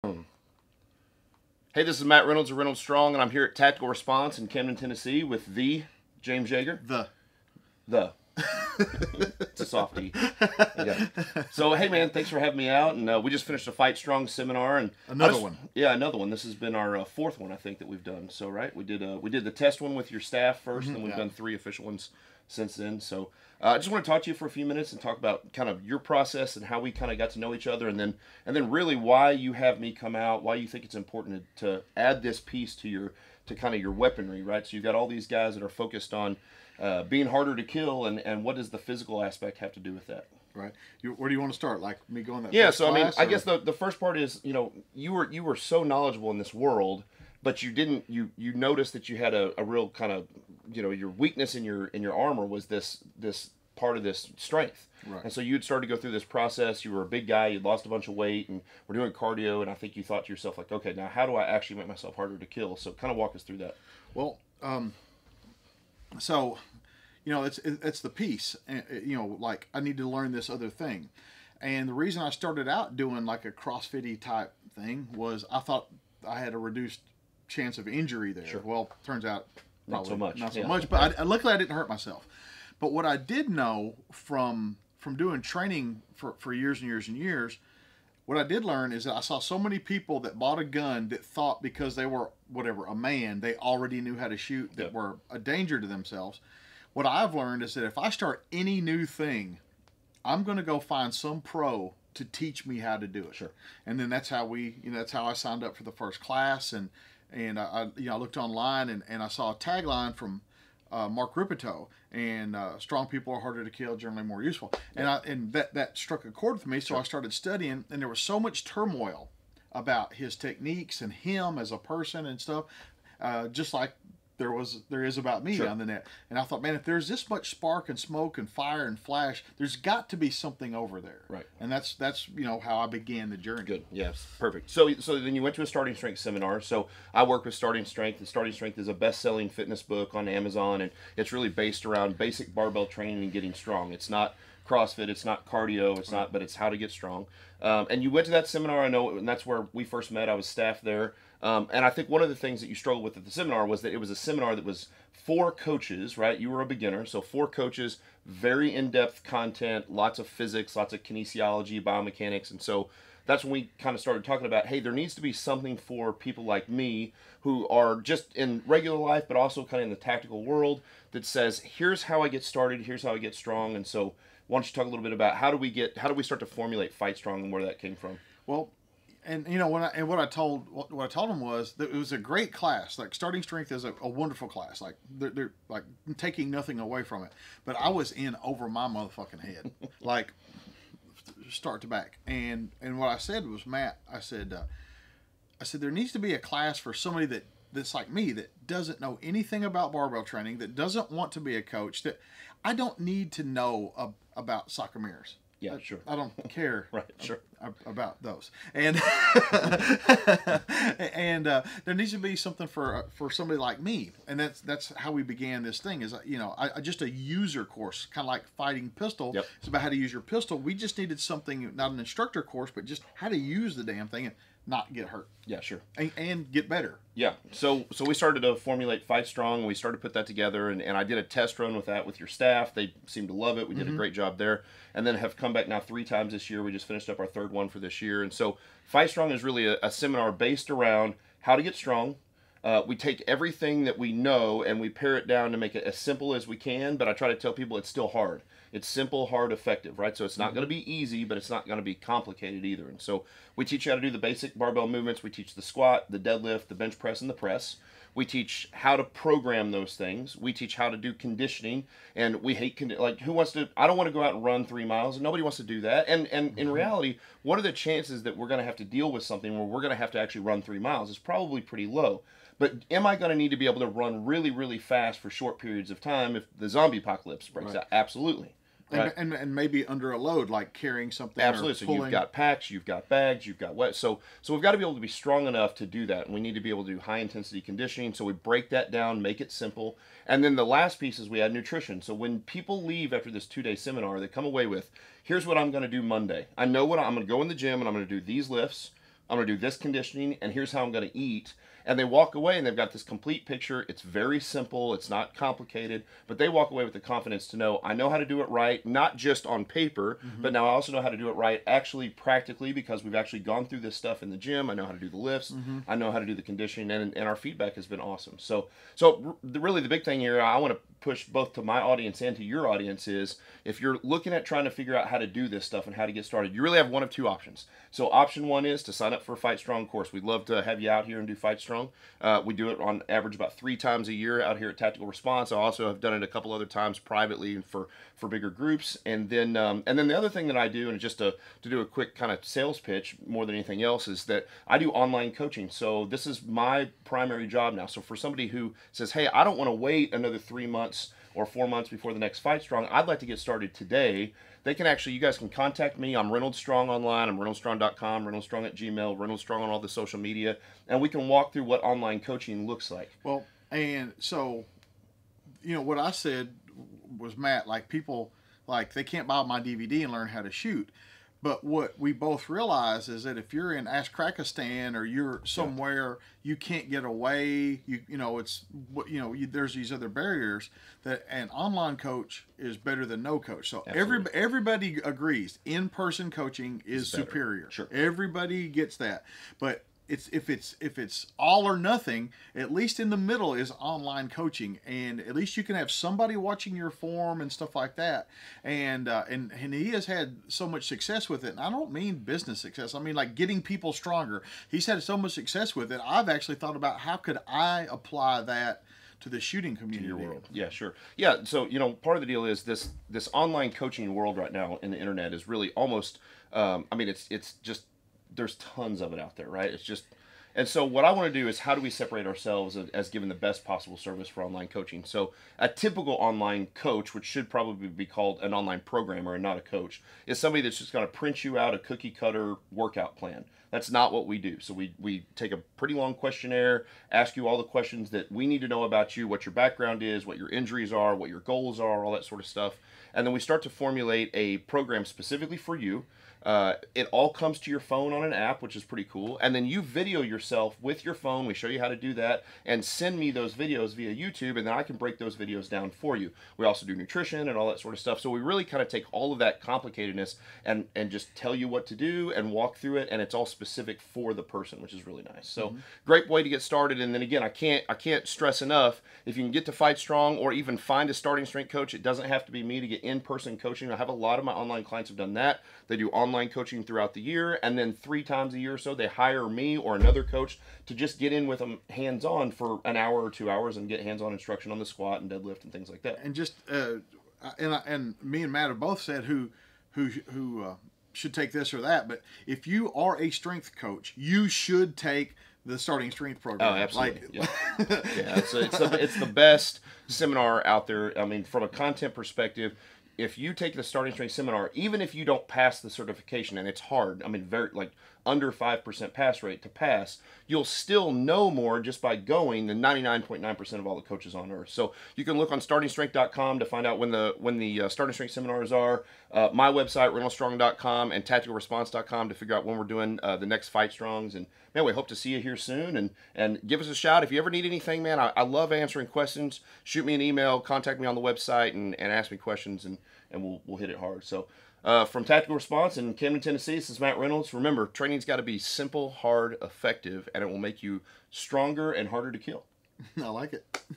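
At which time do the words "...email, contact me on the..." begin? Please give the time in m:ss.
8:50.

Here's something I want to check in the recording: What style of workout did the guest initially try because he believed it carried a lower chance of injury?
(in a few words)
CrossFit.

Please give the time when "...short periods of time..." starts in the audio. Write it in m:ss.
4:35.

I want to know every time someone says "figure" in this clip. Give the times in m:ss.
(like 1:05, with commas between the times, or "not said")
5:24, 8:42.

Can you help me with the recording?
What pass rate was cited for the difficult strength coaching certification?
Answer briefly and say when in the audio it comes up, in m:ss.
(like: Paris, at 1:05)
under 5%, at 8:28.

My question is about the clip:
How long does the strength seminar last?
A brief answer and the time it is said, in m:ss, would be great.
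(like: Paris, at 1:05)
2 days, at 4:53.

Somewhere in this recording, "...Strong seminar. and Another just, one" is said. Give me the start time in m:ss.
0:13.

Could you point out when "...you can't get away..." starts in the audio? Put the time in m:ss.
6:16.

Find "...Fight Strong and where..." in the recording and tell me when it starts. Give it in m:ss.
2:56.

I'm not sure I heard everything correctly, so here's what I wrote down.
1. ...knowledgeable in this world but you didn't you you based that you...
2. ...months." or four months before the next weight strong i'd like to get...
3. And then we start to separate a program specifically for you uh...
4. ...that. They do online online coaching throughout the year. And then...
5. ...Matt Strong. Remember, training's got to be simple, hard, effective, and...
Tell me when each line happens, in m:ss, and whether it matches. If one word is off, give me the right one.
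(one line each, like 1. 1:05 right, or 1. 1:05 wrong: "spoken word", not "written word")
1. 0:45 wrong: "noticed", not "based"
2. 5:50 wrong: "fight", not "weight"
3. 7:23 wrong: "formulate", not "separate"
4. 7:55 right
5. 8:56 wrong: "Reynolds", not "Strong".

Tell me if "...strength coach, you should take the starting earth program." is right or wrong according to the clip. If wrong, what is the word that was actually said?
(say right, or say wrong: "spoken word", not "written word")
wrong: "strength", not "earth".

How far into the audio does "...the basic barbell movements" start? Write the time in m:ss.
4:14.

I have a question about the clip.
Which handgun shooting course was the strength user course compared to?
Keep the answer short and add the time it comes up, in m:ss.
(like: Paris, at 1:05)
Fighting Pistol, at 3:38.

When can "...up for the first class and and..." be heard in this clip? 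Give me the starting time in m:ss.
1:45.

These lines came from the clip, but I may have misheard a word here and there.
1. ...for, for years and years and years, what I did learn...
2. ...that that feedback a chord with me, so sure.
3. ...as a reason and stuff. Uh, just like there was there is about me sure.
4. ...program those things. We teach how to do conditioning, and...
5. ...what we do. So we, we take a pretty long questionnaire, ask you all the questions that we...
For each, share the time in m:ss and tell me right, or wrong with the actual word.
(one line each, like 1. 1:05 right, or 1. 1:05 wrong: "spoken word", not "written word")
1. 1:26 right
2. 1:55 wrong: "struck", not "feedback"
3. 2:01 wrong: "person", not "reason"
4. 4:19 right
5. 7:14 right.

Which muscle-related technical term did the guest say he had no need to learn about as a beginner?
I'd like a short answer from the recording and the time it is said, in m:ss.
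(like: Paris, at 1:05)
sarcomeres, at 3:24.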